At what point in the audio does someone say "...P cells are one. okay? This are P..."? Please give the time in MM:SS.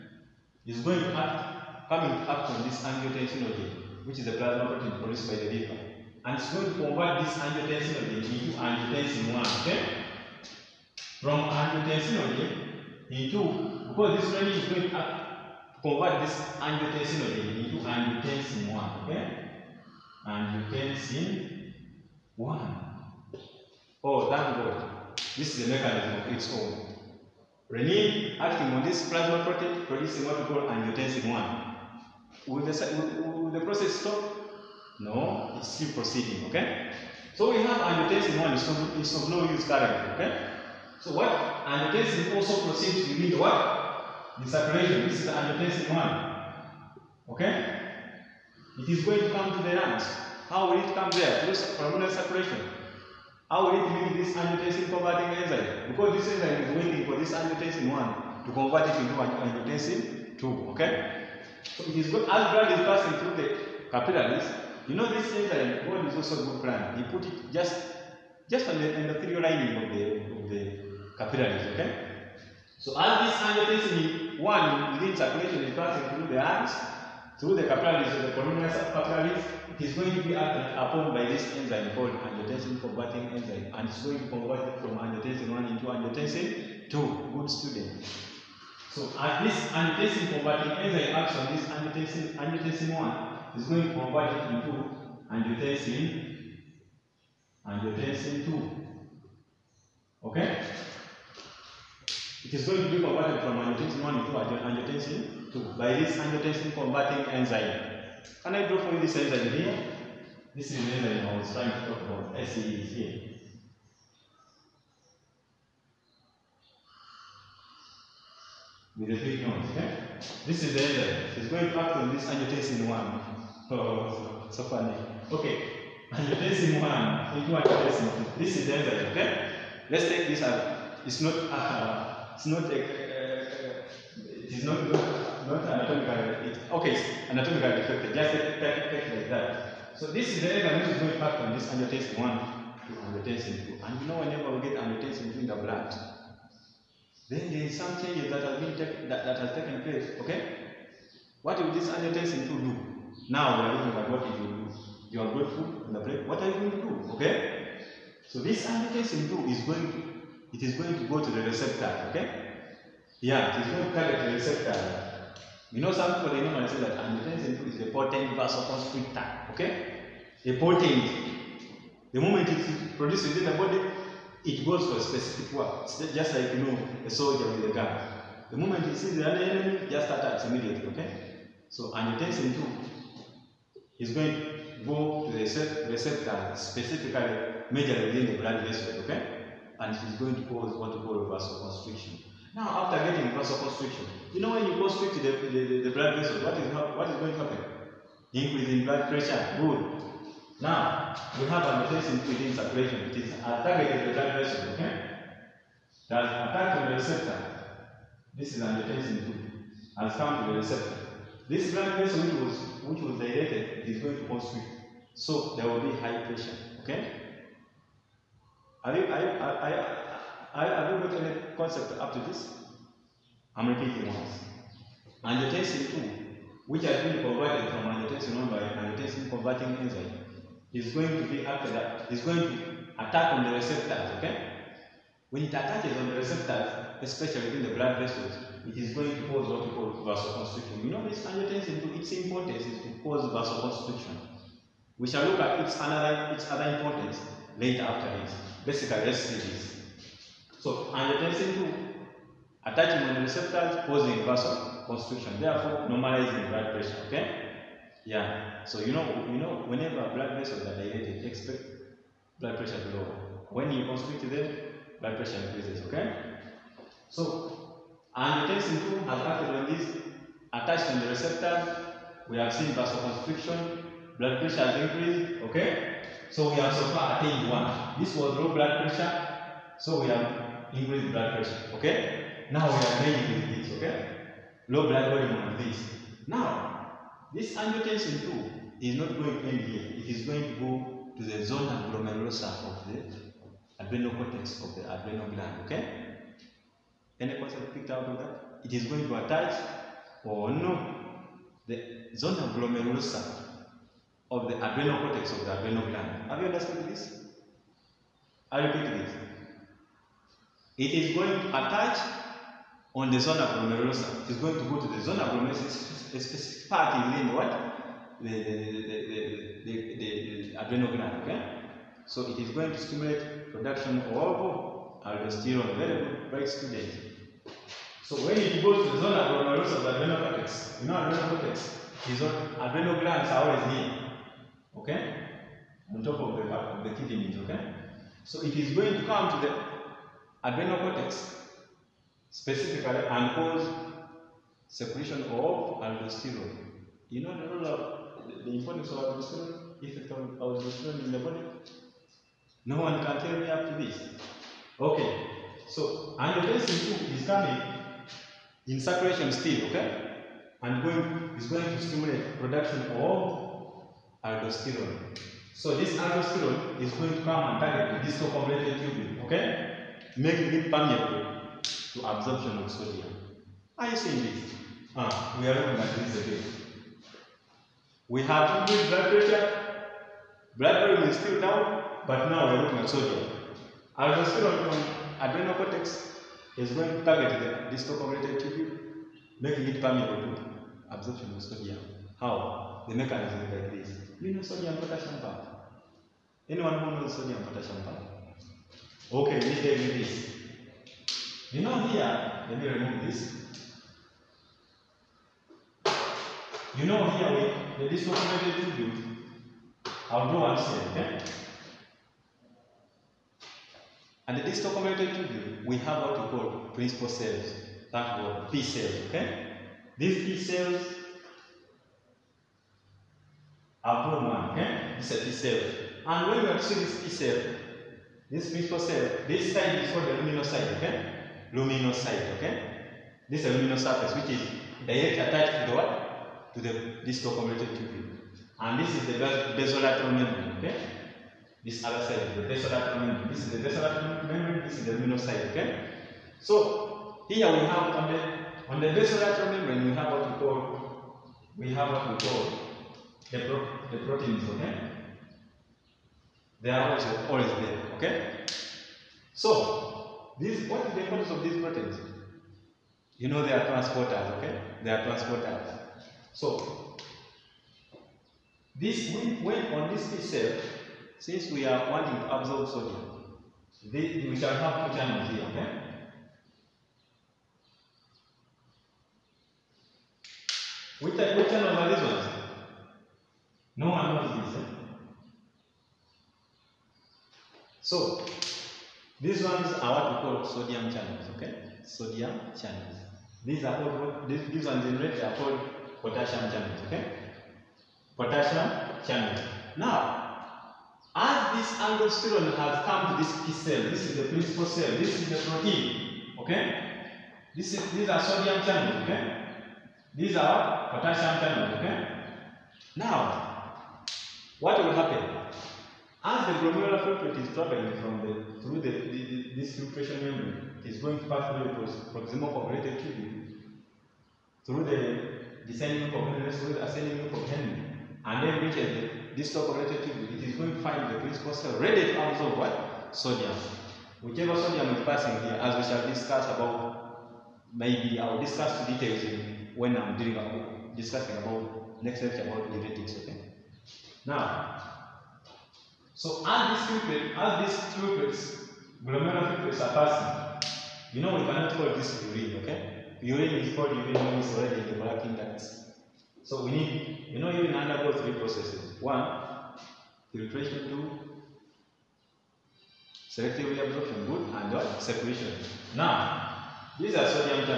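07:00.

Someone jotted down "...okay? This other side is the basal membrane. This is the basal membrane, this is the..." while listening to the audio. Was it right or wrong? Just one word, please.
right.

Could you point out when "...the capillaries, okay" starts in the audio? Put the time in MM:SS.
01:10.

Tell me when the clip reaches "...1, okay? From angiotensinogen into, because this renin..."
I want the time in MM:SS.
00:09.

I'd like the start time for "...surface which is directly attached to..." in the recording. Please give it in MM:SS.
07:13.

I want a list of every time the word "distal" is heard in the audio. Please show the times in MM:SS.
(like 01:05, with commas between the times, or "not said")
06:08, 06:27, 06:54, 07:17, 08:49.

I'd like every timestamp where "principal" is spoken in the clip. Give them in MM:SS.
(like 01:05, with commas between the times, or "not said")
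06:56, 07:08, 08:24, 08:51.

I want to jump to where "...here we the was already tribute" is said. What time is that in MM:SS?
06:47.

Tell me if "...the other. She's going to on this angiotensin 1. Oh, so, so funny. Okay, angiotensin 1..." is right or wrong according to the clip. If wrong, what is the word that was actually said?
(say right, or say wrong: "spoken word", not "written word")
right.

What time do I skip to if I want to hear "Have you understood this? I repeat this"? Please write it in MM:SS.
05:06.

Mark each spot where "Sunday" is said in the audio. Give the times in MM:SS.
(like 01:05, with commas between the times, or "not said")
not said.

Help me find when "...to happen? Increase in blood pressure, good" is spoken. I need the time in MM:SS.
03:17.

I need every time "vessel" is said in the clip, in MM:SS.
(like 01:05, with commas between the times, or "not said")
03:08, 03:16, 03:31, 03:57, 04:20.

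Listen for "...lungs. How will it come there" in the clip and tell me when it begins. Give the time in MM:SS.
00:49.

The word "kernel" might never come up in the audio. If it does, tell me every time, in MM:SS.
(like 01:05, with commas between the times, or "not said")
not said.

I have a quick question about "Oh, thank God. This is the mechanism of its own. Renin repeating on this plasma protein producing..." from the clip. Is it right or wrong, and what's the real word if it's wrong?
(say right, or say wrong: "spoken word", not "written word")
wrong: "acting", not "repeating".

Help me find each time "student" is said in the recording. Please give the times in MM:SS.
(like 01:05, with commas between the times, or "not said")
01:27, 05:26.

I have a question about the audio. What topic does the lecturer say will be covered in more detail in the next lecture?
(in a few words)
Diuretics.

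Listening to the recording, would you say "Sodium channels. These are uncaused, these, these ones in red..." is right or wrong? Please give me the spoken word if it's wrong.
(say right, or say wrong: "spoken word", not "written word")
wrong: "called", not "uncaused".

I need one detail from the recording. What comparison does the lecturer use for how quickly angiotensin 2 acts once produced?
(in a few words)
A soldier with a gun.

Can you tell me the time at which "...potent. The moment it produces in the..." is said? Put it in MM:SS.
02:50.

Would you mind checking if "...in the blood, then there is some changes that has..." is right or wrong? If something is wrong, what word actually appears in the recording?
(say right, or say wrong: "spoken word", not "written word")
right.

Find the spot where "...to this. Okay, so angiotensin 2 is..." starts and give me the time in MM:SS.
05:53.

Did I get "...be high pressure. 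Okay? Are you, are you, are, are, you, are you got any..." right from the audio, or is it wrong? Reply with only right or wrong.
right.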